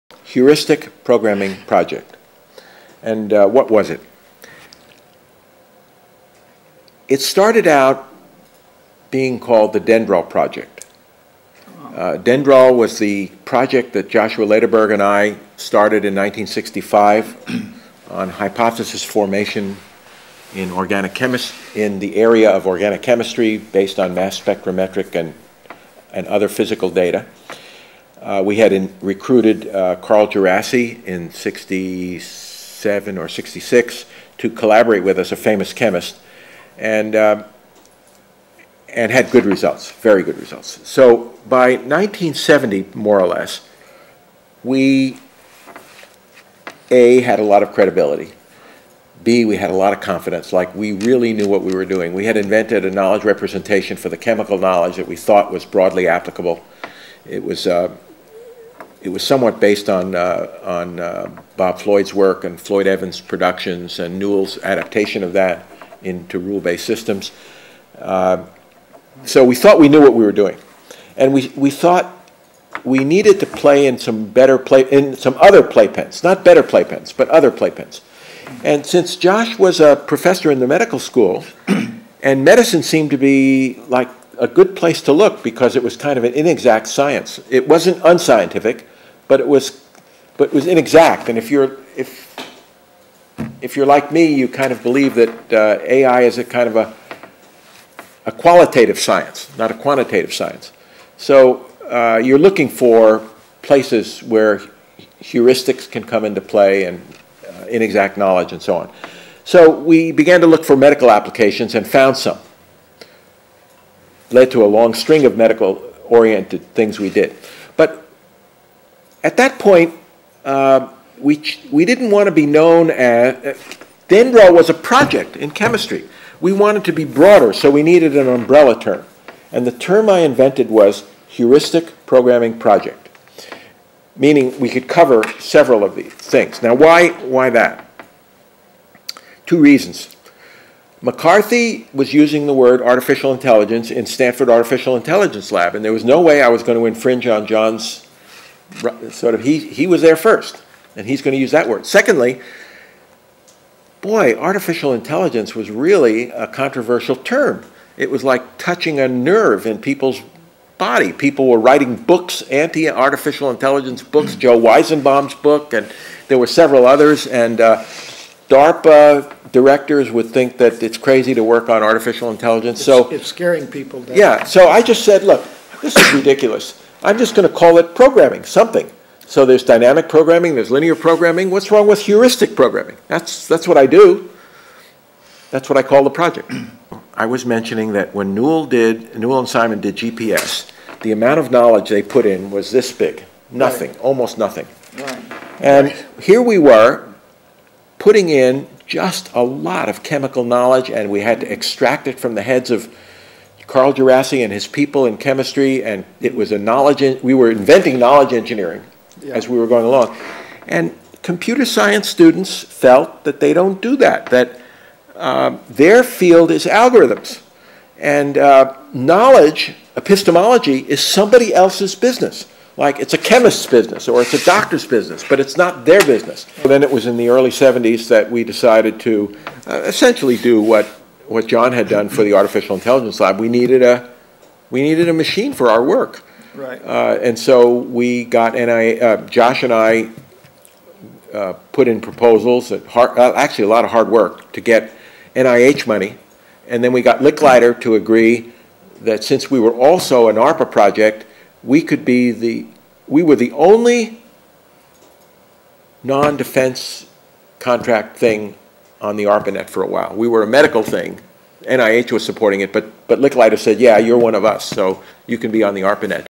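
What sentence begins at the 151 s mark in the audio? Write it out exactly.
Secondly, boy, artificial intelligence was really a controversial term.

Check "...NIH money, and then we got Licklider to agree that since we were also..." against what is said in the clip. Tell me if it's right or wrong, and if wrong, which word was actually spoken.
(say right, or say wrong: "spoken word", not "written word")
right.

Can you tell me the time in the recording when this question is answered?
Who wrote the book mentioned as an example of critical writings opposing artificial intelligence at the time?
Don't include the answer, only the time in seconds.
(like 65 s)
164 s.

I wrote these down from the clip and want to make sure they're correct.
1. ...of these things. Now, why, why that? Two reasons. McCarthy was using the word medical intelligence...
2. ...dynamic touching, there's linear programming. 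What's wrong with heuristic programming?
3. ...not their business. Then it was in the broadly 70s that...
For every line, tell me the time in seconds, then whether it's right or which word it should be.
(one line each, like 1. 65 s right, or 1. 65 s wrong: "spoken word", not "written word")
1. 135 s wrong: "artificial", not "medical"
2. 179 s wrong: "programming", not "touching"
3. 225 s wrong: "early", not "broadly".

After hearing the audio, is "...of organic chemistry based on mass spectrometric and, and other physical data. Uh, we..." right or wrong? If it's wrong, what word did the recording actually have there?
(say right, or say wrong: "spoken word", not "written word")
right.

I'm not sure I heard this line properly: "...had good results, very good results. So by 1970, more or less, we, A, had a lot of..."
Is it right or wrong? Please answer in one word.
right.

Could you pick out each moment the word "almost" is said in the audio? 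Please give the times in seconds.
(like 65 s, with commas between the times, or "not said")
194 s.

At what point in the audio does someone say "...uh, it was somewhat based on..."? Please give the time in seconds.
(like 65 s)
57 s.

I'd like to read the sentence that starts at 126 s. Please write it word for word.
We wanted to be broader, so we needed an umbrella term.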